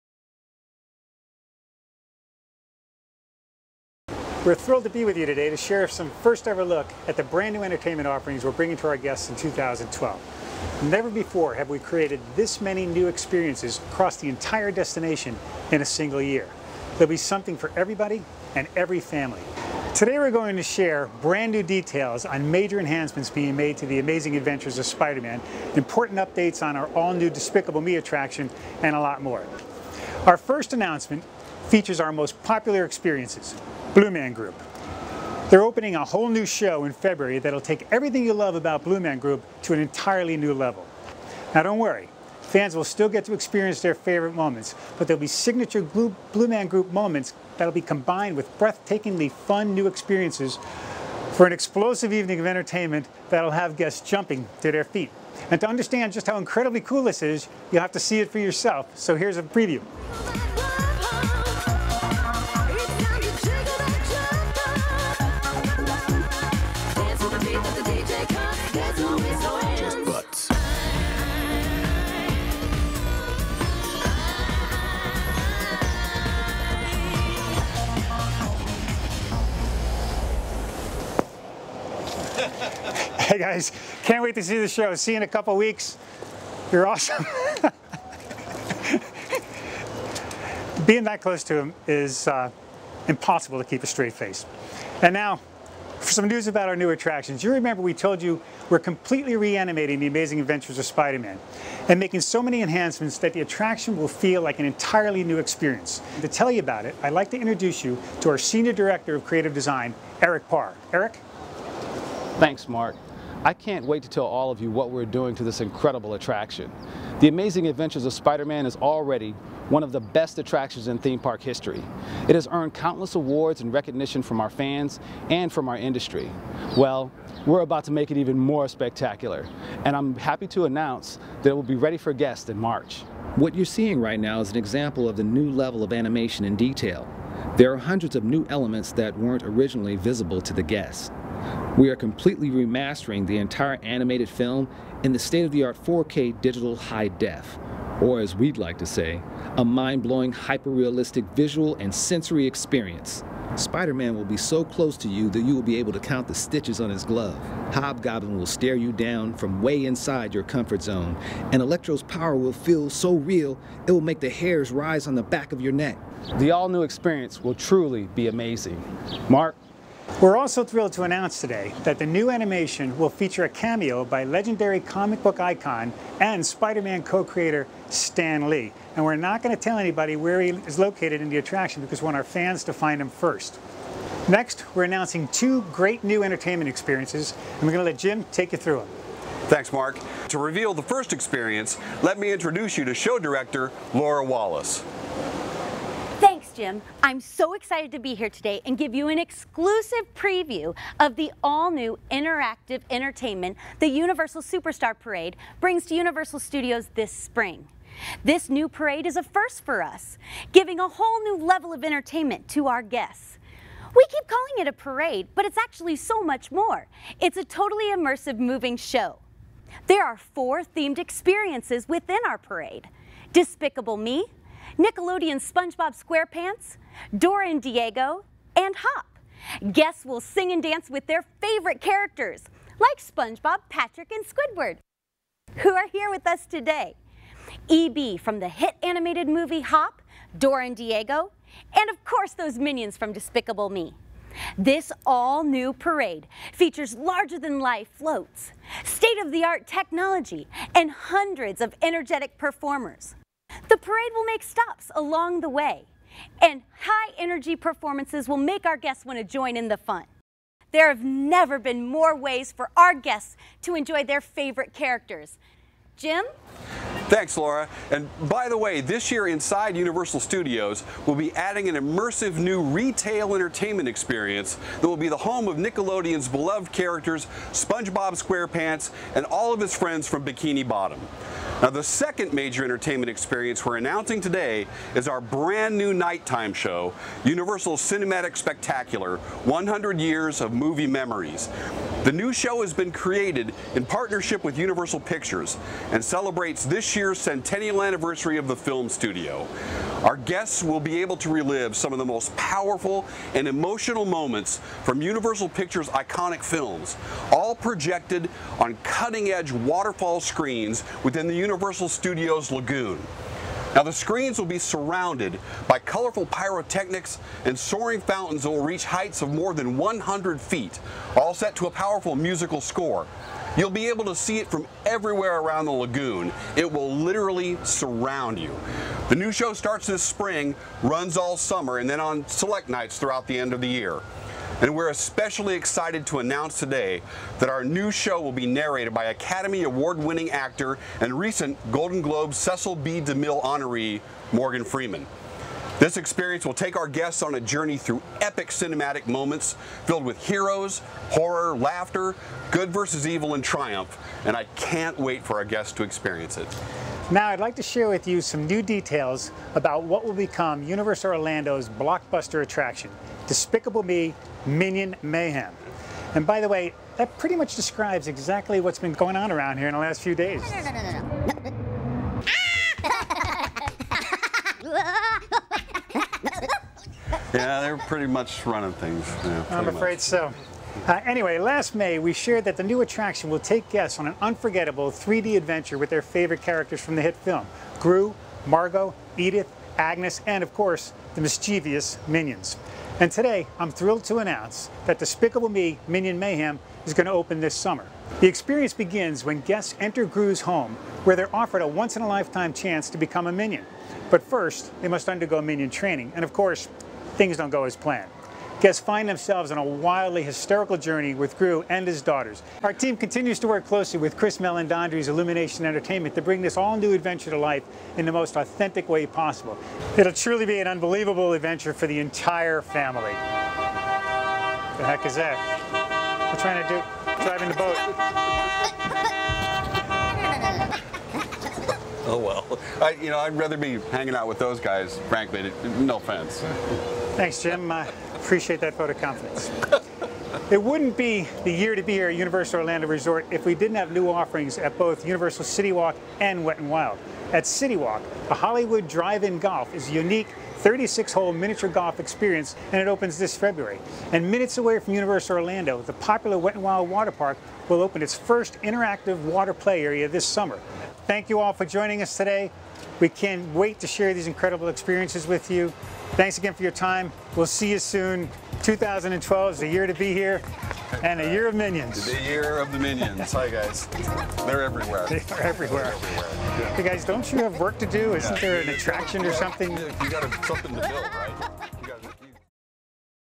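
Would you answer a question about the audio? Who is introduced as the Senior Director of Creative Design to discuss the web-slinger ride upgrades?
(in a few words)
Eric Parr.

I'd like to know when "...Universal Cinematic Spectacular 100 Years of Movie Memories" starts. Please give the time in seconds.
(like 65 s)
287 s.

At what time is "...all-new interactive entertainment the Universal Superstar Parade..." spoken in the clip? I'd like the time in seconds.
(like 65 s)
201 s.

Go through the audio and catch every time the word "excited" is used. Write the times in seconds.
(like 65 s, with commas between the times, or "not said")
197 s, 335 s.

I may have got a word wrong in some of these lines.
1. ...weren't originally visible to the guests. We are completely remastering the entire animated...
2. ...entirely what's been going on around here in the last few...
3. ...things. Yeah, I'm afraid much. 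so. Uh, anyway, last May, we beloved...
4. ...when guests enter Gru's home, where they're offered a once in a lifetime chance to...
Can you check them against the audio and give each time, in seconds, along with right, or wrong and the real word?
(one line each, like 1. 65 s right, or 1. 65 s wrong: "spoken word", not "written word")
1. 139 s right
2. 368 s wrong: "exactly", not "entirely"
3. 378 s wrong: "shared", not "beloved"
4. 399 s right.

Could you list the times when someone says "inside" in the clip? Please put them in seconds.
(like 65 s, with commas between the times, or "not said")
159 s, 269 s.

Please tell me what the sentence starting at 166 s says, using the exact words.
The all-new experience will truly be amazing.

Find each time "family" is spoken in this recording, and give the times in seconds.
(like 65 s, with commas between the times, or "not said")
18 s, 422 s.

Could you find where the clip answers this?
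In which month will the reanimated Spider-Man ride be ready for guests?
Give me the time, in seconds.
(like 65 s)
132 s.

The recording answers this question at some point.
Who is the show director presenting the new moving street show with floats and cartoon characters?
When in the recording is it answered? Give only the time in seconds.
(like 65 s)
193 s.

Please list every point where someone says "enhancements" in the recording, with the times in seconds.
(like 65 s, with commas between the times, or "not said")
22 s, 102 s.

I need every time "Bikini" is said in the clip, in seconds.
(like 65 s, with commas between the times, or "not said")
280 s.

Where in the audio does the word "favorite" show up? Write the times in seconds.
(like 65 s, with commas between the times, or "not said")
43 s, 231 s, 264 s, 386 s.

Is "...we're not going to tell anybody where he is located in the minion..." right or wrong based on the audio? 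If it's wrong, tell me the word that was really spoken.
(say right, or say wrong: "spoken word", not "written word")
wrong: "attraction", not "minion".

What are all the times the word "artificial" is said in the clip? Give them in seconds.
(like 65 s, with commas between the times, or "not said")
not said.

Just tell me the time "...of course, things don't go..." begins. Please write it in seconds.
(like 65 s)
406 s.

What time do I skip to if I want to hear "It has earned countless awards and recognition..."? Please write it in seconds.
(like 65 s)
122 s.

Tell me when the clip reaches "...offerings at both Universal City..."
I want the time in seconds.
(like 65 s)
444 s.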